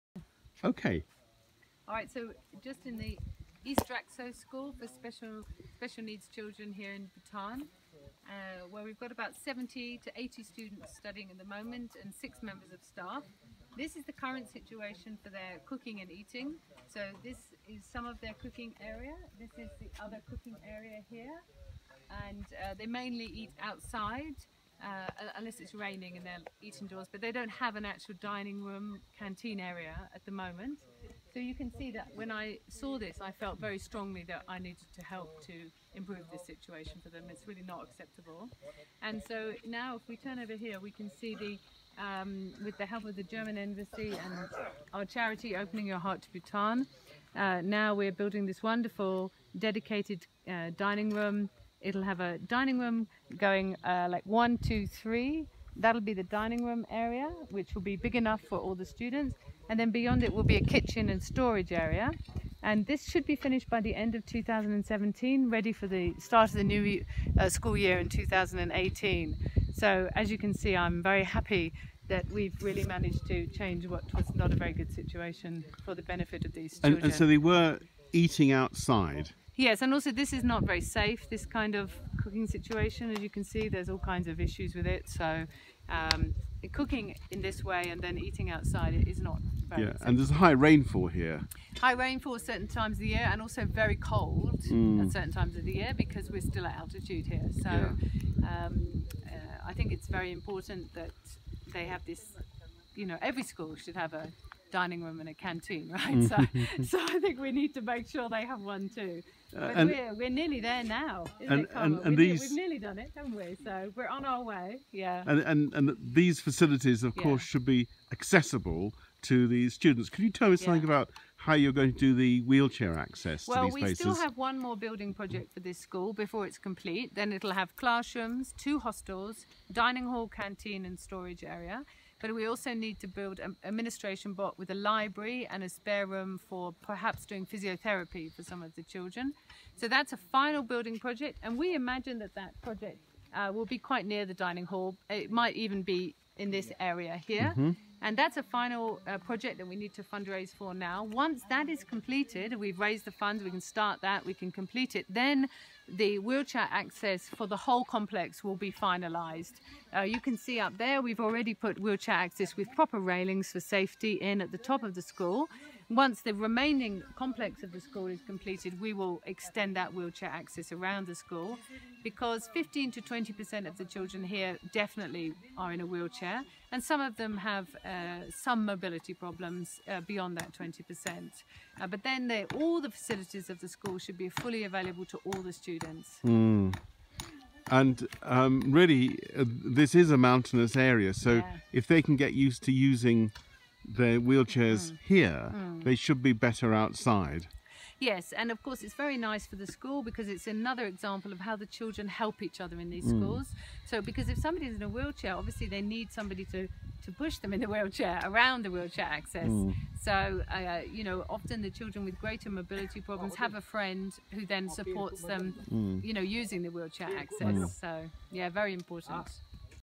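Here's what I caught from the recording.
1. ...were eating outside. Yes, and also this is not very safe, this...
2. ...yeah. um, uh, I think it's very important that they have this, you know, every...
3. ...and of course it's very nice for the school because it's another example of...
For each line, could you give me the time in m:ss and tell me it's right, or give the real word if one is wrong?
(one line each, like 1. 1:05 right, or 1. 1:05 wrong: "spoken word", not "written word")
1. 1:17 right
2. 1:38 right
3. 3:18 right.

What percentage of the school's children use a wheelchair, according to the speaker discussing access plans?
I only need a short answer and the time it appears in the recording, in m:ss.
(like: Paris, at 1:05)
15 to 20%, at 2:52.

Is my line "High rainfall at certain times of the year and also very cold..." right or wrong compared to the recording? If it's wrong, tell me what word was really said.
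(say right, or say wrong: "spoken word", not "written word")
right.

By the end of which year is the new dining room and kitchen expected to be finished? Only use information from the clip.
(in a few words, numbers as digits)
2017.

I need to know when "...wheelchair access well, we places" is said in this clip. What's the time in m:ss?
2:02.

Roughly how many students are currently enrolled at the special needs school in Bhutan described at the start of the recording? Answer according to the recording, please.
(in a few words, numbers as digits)
70 to 80.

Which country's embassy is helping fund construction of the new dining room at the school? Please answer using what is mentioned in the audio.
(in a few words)
German.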